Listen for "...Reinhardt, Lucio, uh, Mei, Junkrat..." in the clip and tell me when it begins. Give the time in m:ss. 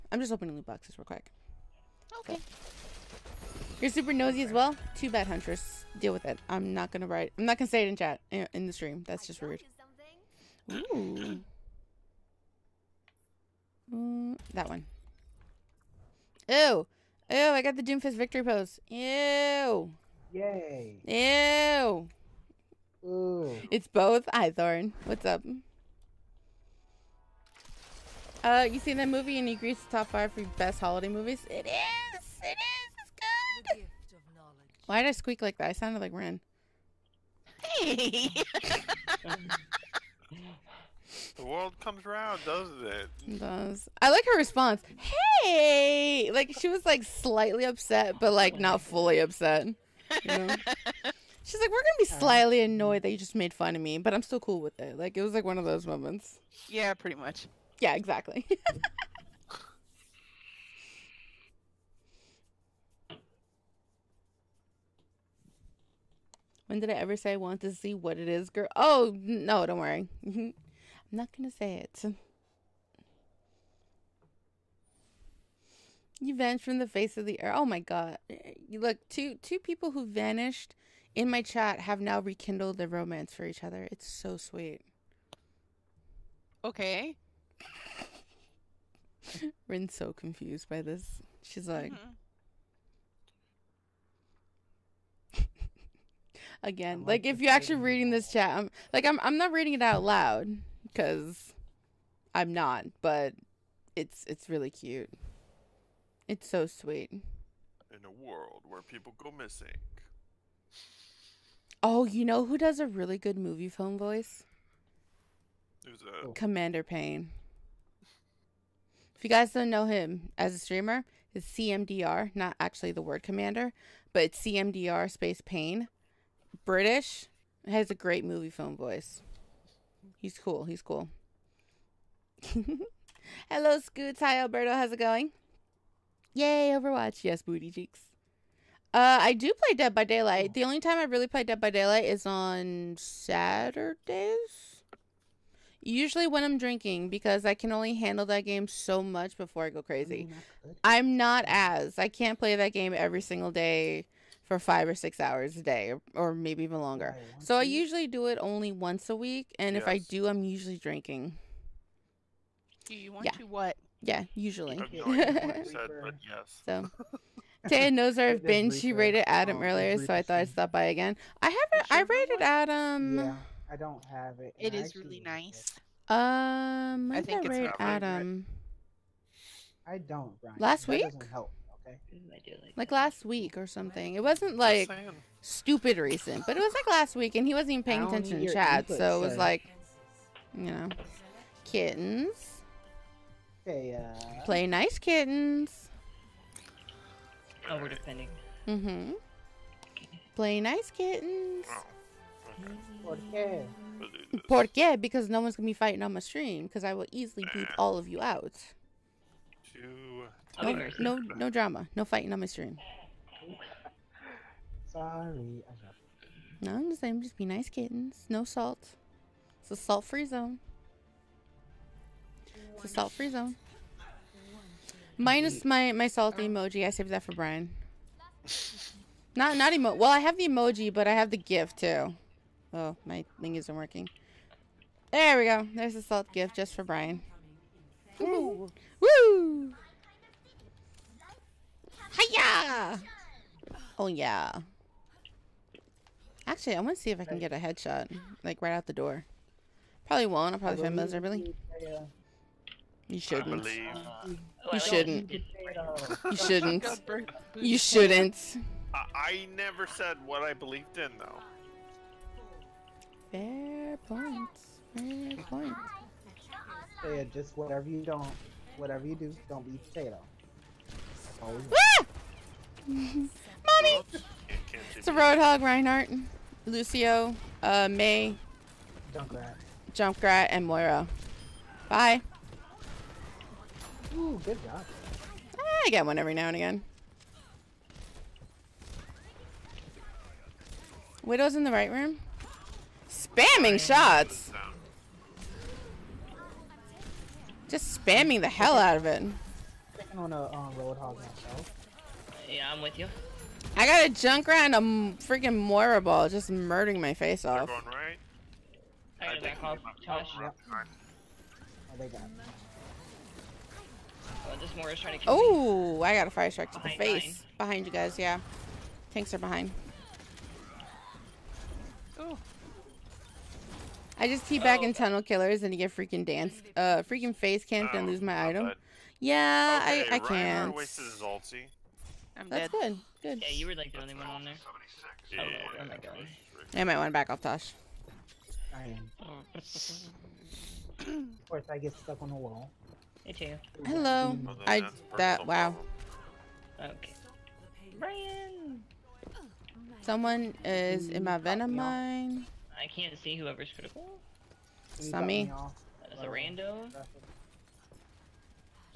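4:35.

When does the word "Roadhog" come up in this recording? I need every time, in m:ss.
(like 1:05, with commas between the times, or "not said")
4:35, 5:00.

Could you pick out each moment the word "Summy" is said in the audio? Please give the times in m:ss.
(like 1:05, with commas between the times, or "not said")
5:54.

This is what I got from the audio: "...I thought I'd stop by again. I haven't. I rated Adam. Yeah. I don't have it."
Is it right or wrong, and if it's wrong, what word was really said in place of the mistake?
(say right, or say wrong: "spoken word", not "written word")
right.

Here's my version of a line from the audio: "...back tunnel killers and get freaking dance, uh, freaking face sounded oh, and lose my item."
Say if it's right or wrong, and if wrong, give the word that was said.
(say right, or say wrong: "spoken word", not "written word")
wrong: "camped", not "sounded".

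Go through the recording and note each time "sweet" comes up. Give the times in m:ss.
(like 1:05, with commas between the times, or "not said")
1:24, 1:46.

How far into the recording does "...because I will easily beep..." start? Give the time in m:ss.
3:26.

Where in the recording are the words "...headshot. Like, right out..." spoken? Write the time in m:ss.
4:07.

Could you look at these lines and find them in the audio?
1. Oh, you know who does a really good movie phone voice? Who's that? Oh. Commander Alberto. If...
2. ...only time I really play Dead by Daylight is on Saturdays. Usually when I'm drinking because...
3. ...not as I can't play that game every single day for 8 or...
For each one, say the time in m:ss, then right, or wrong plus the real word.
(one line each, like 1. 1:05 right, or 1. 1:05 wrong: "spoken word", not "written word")
1. 1:51 wrong: "Payne", not "Alberto"
2. 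2:20 right
3. 2:31 wrong: "5", not "8".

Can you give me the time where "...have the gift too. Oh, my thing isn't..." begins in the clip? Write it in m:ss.
3:51.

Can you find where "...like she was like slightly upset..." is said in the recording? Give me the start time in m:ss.
0:46.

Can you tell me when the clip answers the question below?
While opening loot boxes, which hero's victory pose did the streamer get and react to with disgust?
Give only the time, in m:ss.
0:17.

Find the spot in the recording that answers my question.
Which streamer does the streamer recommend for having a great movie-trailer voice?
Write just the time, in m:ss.
2:04.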